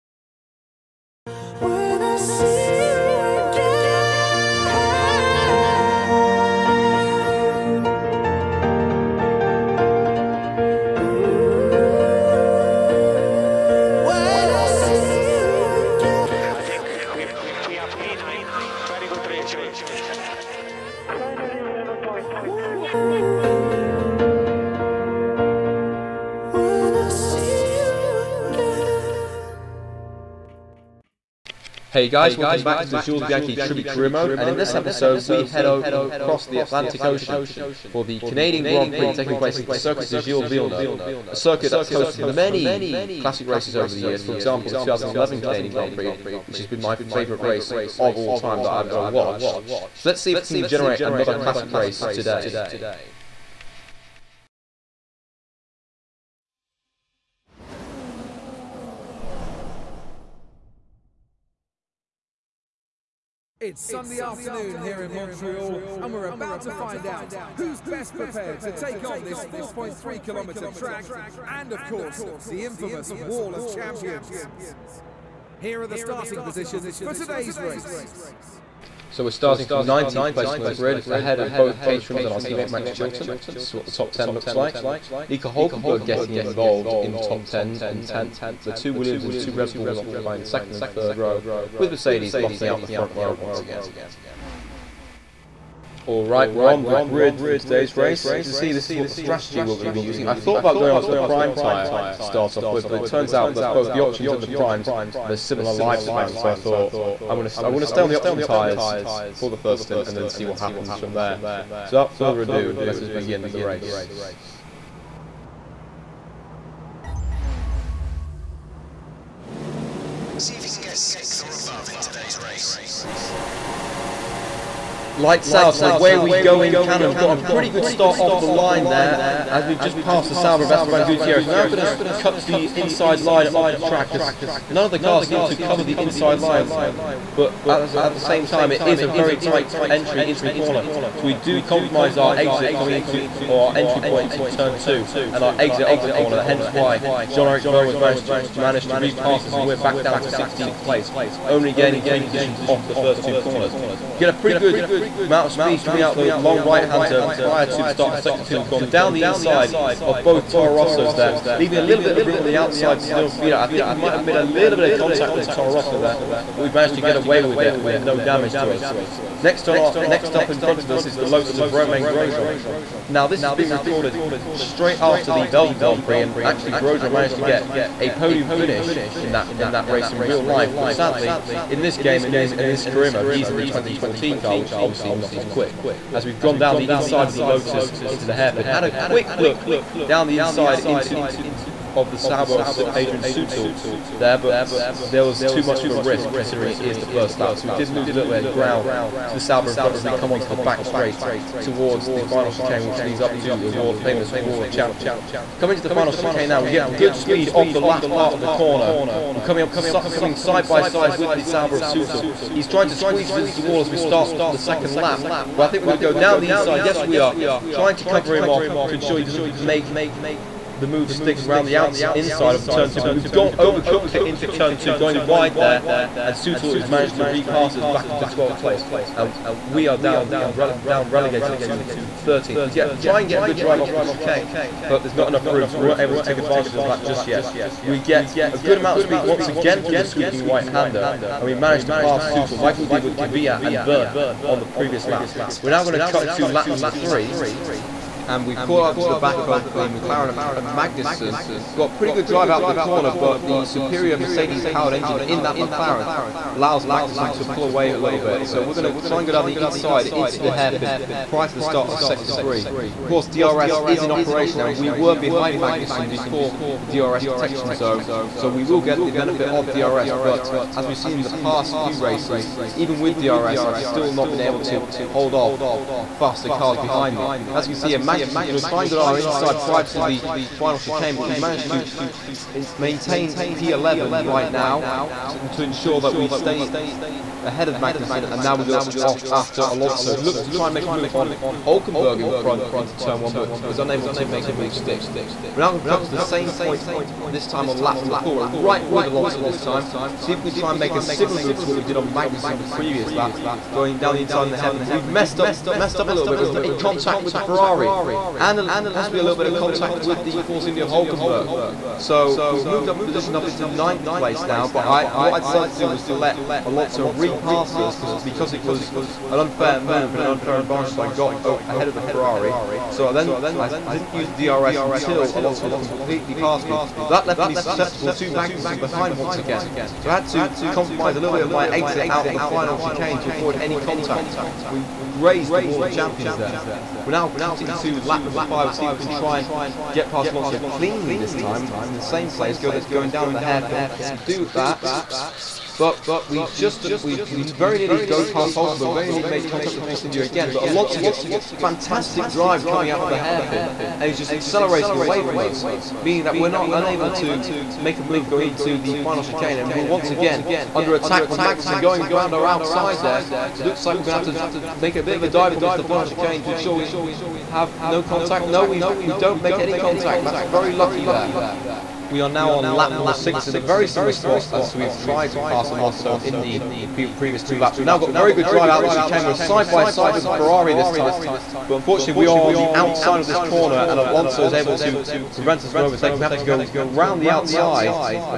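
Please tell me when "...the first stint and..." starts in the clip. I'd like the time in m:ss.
1:49.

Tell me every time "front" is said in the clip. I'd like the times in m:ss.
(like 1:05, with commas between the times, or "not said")
1:32, 2:50, 3:19, 4:52.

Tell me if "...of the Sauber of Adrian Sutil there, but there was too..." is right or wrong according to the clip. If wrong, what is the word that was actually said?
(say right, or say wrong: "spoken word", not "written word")
right.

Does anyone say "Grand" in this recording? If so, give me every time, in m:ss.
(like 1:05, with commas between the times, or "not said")
0:38, 0:45, 2:55.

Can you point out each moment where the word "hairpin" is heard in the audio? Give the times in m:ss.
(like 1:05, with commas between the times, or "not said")
3:08, 4:20, 5:04, 5:43, 5:53.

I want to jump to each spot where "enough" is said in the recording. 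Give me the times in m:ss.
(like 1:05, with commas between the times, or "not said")
3:55.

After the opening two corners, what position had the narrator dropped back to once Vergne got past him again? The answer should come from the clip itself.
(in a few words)
16th.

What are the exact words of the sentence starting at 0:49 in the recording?
So let's see if we can generate another classic race today.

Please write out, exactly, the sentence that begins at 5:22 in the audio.
So then I didn't use DRS until Alonso was completely past me.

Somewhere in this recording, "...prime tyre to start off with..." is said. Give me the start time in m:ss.
1:41.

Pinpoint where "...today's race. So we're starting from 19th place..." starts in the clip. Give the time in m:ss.
1:17.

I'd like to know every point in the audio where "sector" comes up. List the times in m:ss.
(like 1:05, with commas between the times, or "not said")
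2:38, 4:21.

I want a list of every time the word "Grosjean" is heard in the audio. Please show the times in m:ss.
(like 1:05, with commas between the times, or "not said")
2:52, 2:56.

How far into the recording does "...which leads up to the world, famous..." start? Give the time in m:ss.
3:22.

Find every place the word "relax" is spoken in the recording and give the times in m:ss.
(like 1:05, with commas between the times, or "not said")
not said.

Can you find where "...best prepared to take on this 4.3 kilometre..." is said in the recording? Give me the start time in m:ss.
1:07.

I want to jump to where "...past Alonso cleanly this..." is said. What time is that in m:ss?
5:40.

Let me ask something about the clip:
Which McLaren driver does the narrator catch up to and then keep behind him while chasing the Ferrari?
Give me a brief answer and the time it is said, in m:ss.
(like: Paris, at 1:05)
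Kevin Magnussen, at 4:10.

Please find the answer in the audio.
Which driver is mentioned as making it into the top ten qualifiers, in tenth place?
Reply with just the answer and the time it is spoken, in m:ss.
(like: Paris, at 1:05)
Nico Hulkenberg, at 1:25.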